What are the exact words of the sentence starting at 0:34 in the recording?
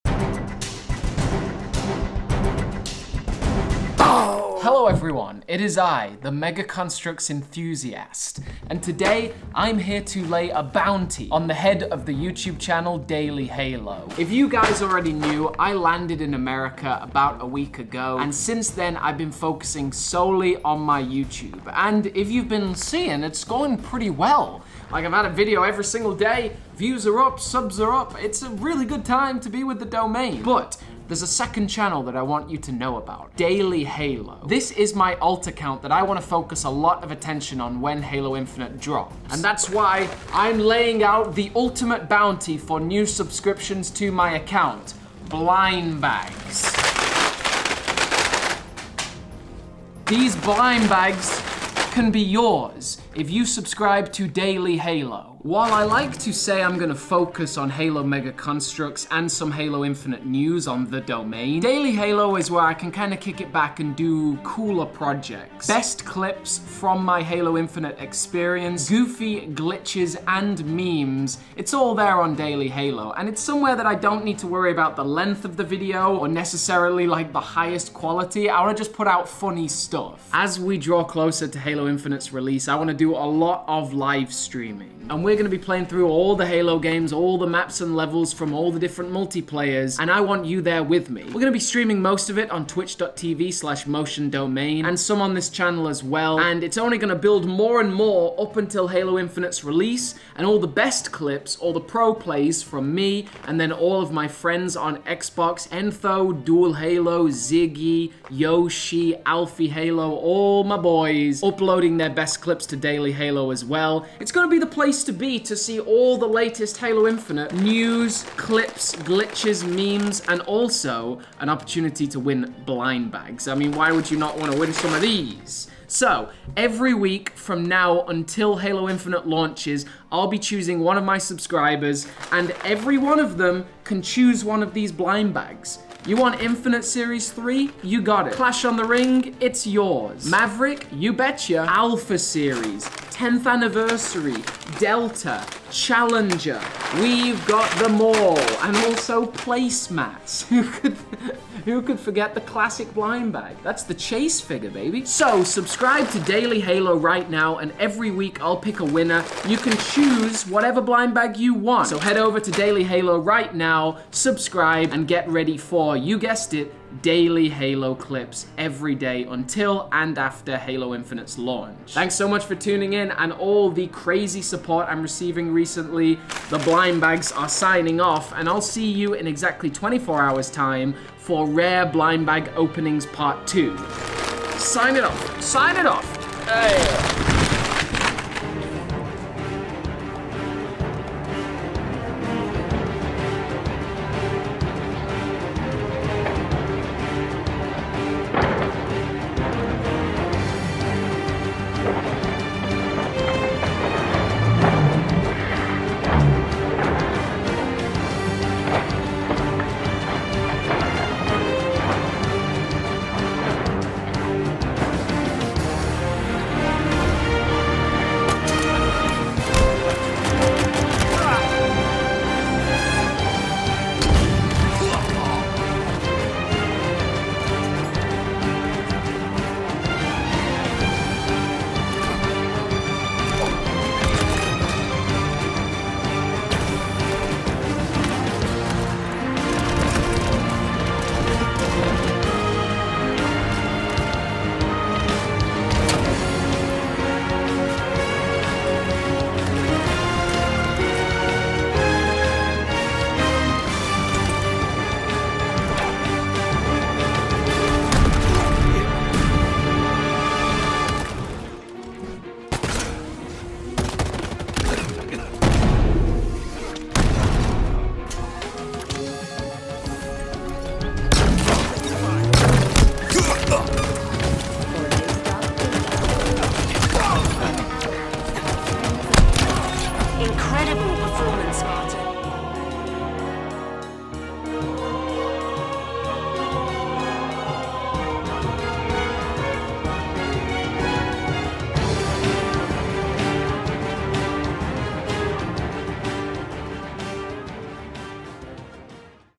This is my alt account that I want to focus a lot of attention on when Halo Infinite drops.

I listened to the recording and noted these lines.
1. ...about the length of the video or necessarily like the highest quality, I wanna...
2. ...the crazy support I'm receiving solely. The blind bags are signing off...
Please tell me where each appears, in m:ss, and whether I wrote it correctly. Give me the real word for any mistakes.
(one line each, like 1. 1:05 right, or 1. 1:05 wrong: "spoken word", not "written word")
1. 1:14 right
2. 2:53 wrong: "recently", not "solely".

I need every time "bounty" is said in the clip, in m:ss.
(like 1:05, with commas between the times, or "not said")
0:10, 0:42.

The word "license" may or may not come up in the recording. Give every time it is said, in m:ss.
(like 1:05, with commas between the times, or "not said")
not said.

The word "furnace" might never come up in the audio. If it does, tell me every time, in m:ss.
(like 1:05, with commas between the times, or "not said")
not said.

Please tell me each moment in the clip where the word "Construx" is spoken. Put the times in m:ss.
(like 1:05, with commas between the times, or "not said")
0:06, 0:58.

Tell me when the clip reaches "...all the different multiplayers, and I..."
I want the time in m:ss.
1:28.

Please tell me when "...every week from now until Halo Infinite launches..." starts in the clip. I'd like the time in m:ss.
2:06.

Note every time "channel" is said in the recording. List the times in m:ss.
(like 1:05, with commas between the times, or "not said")
0:12, 0:31, 1:35.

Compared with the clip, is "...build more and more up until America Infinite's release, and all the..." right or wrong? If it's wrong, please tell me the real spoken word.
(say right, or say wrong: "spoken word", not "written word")
wrong: "Halo", not "America".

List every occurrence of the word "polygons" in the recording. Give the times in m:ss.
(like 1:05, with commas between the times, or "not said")
not said.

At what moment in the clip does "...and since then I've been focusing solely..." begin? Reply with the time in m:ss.
0:18.